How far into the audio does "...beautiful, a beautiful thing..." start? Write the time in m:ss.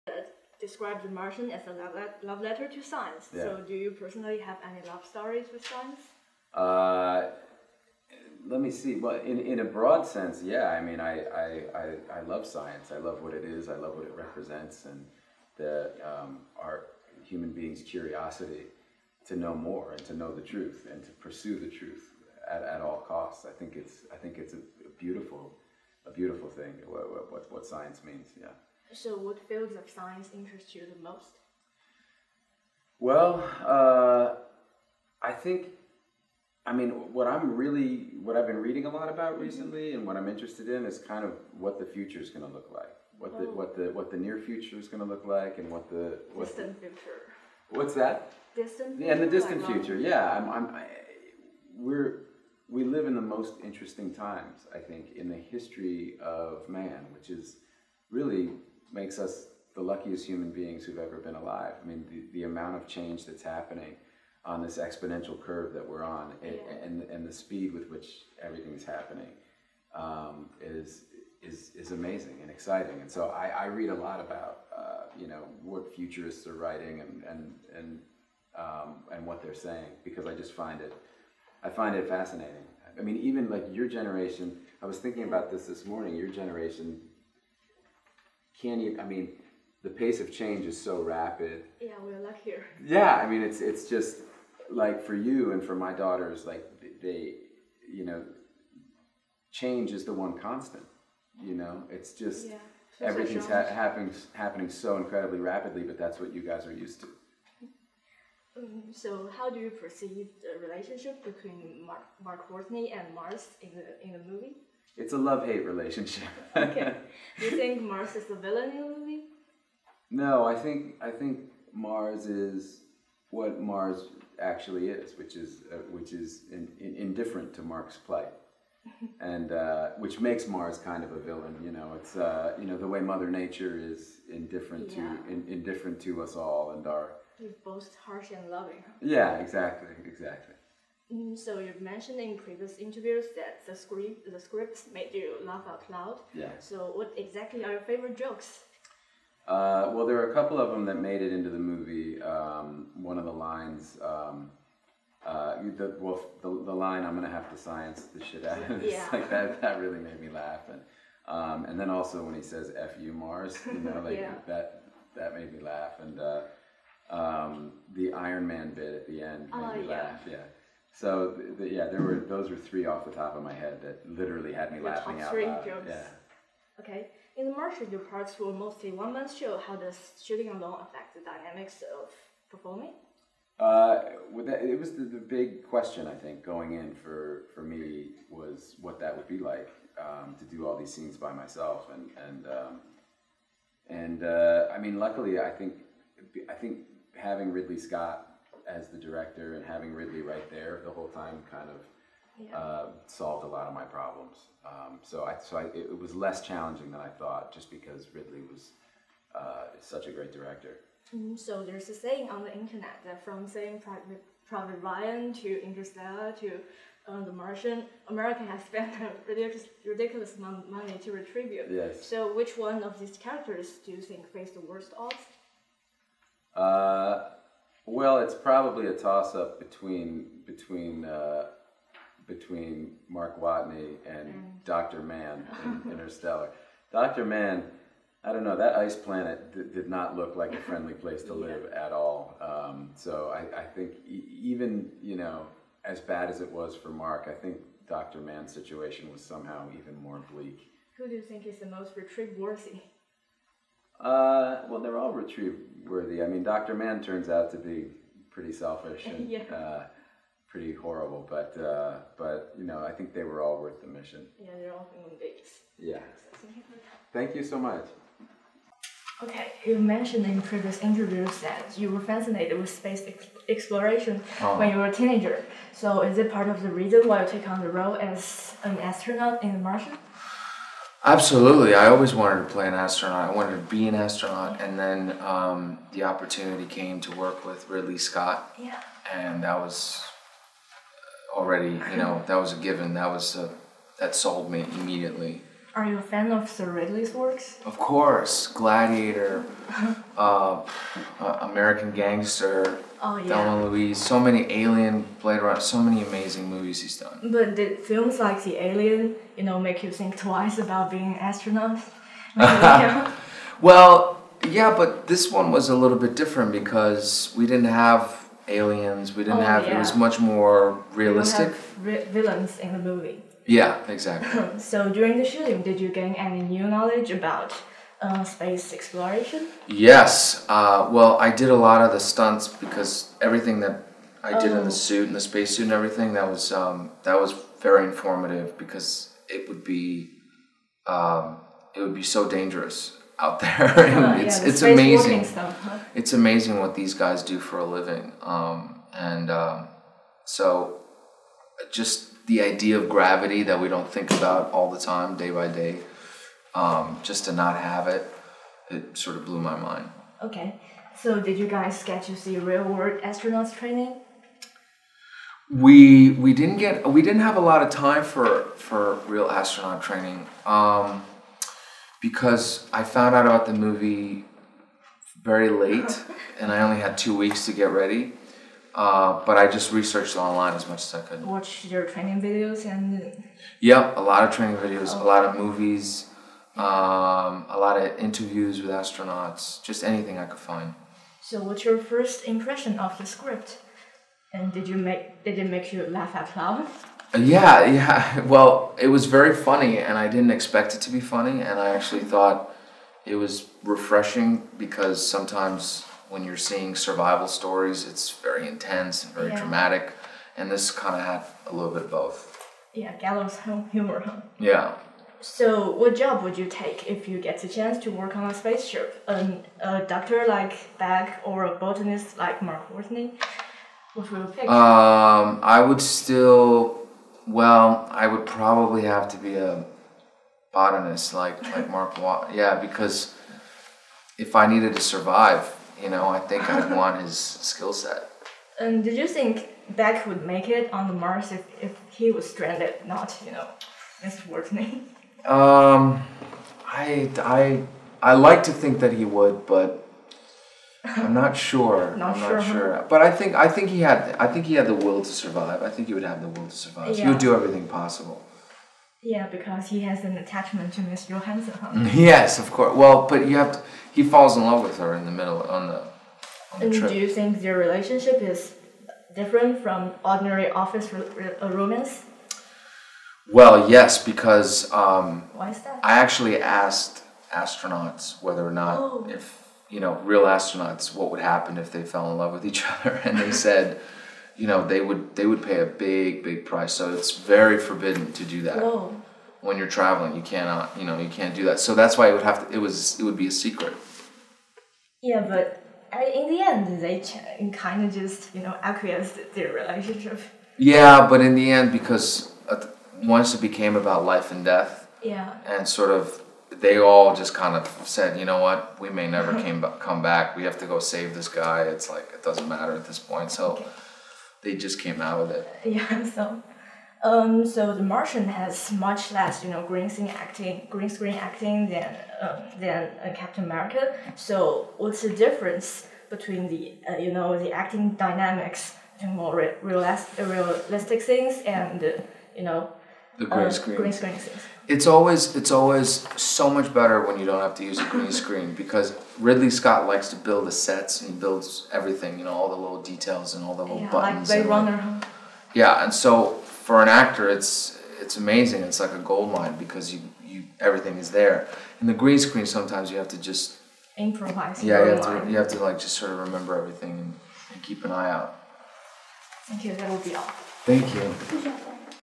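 0:24.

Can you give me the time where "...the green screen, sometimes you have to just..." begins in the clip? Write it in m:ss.
9:11.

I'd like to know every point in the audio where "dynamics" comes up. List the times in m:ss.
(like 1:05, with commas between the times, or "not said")
3:01, 8:47.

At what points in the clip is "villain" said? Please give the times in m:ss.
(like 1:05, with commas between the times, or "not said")
1:58, 2:11, 5:21.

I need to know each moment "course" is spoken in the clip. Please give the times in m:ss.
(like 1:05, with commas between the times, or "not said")
4:57, 7:42.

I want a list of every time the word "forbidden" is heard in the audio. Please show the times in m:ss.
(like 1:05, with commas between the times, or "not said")
8:07.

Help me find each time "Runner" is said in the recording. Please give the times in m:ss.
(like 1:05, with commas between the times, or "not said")
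5:05, 9:04.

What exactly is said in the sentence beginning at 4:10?
Who do you think is the most retrieve-worthy?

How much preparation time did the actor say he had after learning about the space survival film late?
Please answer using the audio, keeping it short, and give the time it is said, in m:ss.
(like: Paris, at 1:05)
2 weeks, at 6:16.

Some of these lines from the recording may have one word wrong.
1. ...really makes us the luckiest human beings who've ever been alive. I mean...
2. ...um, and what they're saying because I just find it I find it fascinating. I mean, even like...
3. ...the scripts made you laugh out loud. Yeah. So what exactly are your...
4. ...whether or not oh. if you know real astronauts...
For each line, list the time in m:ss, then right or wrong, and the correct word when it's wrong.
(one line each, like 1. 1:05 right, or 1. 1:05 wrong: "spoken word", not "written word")
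1. 0:58 right
2. 1:18 right
3. 2:24 right
4. 7:58 right.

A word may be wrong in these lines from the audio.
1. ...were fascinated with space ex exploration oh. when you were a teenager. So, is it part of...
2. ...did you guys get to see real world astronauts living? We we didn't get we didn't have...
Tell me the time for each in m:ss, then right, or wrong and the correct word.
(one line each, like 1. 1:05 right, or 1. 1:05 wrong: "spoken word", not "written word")
1. 4:31 right
2. 6:01 wrong: "training", not "living".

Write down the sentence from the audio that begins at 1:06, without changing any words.
and and the speed with which everything's happening, um, is is is amazing and exciting.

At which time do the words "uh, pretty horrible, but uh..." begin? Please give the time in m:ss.
4:19.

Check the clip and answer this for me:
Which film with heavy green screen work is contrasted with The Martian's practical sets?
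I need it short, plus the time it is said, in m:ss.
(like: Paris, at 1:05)
Captain America, at 8:43.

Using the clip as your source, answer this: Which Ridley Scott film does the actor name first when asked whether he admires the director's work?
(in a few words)
Gladiator.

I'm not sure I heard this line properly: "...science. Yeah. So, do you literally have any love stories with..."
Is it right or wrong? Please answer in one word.
wrong.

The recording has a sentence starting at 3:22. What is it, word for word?
uh, solved a lot of my problems.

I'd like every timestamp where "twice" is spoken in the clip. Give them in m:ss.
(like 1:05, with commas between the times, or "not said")
5:10.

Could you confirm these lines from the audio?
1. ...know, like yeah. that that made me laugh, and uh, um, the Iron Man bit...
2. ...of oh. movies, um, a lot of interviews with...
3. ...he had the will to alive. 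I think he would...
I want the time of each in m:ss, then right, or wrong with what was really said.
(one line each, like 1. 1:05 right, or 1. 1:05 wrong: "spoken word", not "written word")
1. 2:43 right
2. 6:25 right
3. 7:34 wrong: "survive", not "alive".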